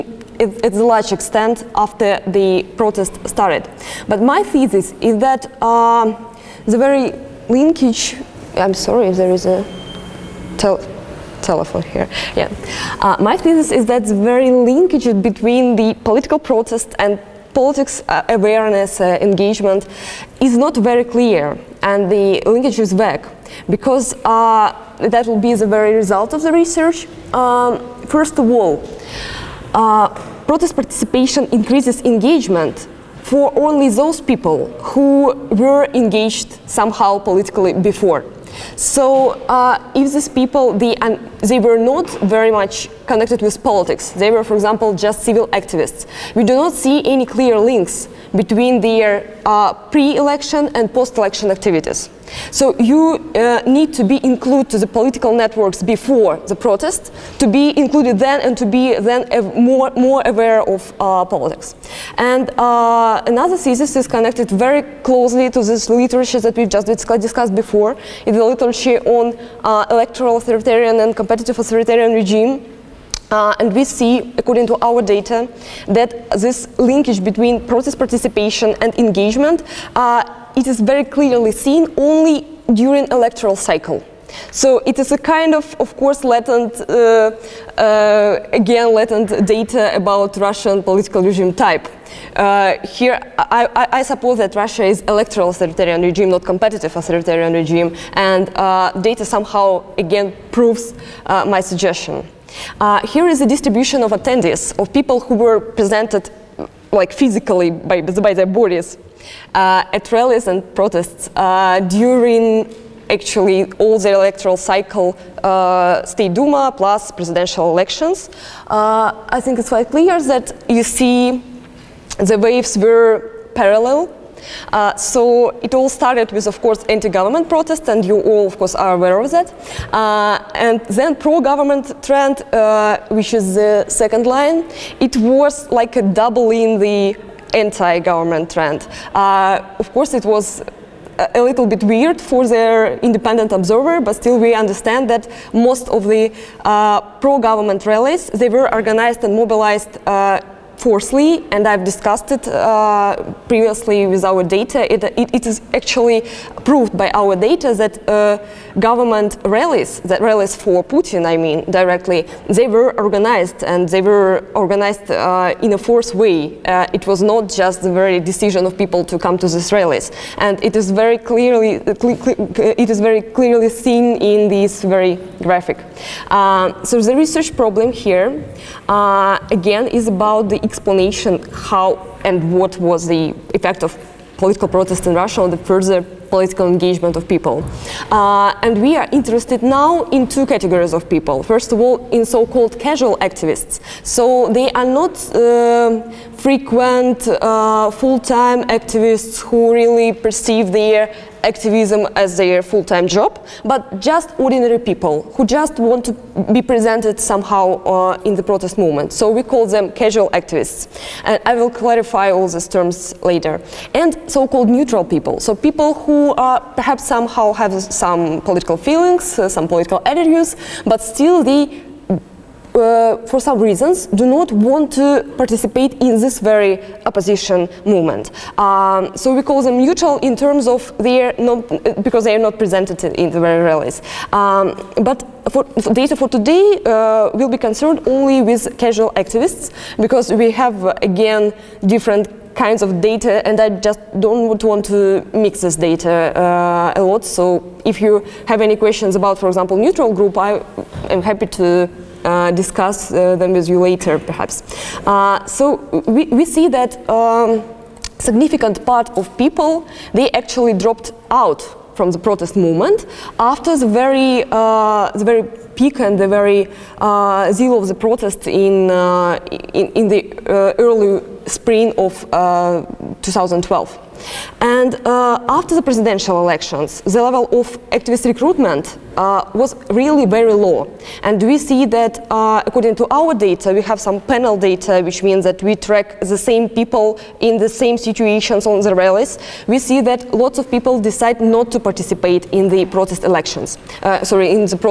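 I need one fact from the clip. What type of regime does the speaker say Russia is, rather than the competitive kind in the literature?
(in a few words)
Electoral authoritarian regime.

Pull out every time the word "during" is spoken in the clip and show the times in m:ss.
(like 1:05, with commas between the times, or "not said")
1:22, 1:51.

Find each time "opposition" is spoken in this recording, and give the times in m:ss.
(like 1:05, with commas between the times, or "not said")
3:47.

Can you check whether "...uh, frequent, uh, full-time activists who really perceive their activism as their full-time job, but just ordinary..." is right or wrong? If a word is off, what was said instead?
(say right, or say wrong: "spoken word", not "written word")
right.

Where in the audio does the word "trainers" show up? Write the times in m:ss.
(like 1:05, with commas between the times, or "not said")
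not said.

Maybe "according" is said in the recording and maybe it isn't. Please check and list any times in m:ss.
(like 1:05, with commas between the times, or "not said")
1:14, 4:42.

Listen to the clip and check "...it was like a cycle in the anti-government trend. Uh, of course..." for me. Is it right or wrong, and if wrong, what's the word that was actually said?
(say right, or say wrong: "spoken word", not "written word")
wrong: "double", not "cycle".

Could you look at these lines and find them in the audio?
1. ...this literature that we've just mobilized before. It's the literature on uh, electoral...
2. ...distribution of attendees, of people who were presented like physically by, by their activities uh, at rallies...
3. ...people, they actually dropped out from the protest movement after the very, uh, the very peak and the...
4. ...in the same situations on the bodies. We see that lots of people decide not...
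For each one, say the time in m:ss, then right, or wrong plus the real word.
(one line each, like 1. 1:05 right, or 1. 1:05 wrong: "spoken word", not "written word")
1. 1:05 wrong: "discussed", not "mobilized"
2. 1:43 wrong: "bodies", not "activities"
3. 4:19 right
4. 4:47 wrong: "rallies", not "bodies".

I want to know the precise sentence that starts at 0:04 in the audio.
But my thesis is that um, the very linkage, I'm sorry if there is a telephone here.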